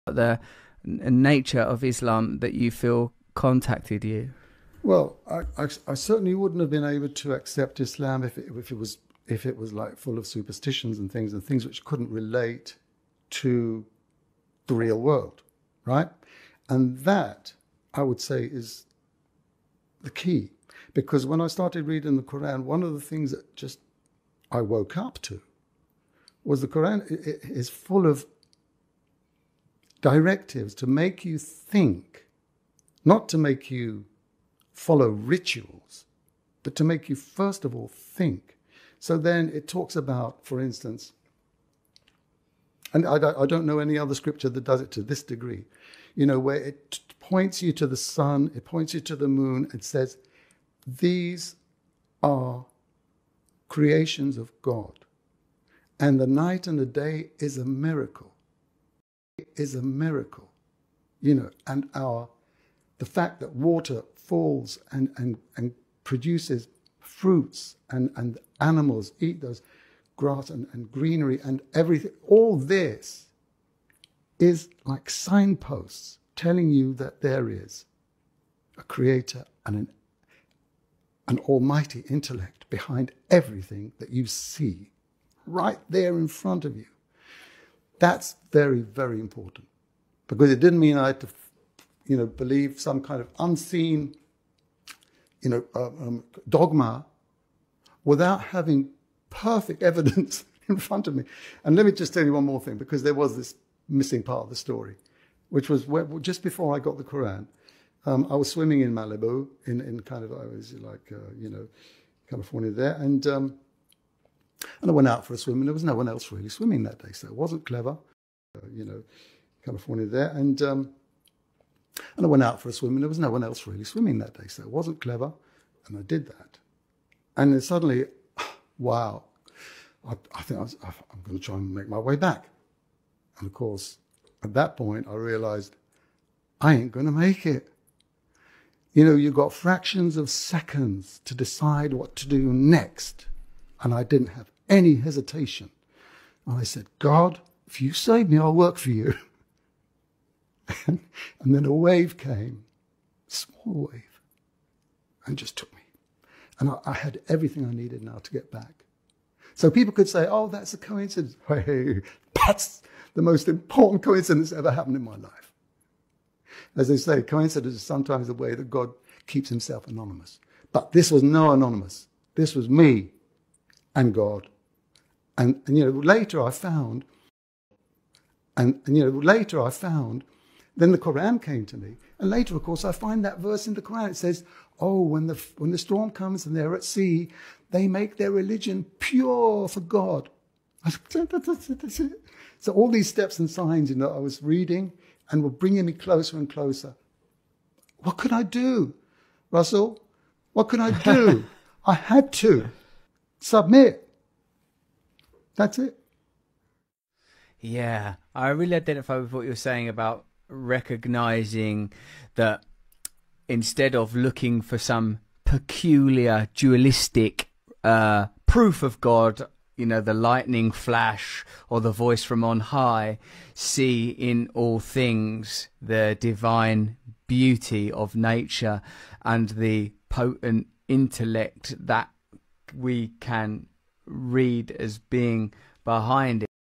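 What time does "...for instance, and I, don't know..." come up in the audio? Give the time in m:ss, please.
0:40.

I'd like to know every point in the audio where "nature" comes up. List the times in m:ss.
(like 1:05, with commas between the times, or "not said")
0:00, 3:48.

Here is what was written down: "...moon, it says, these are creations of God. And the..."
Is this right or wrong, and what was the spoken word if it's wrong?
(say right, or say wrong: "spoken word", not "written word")
right.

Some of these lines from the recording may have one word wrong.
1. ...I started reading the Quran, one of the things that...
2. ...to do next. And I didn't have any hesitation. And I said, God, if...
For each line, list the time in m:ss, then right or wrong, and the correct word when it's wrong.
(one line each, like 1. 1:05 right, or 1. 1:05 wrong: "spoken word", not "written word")
1. 0:21 right
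2. 2:22 right.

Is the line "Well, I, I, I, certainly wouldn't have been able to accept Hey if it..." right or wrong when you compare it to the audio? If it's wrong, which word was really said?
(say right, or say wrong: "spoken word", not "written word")
wrong: "Islam", not "Hey".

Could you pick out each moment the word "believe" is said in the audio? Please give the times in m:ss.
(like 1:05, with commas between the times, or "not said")
1:32.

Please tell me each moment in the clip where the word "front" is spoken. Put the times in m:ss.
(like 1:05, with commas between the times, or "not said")
1:26, 1:40.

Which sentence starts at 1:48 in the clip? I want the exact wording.
Um, I was swimming in Malibu, in, in kind of, I was like, uh, you know, California there.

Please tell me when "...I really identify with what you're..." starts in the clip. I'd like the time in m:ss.
3:28.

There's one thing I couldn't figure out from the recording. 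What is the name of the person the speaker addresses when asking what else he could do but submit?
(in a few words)
Russell.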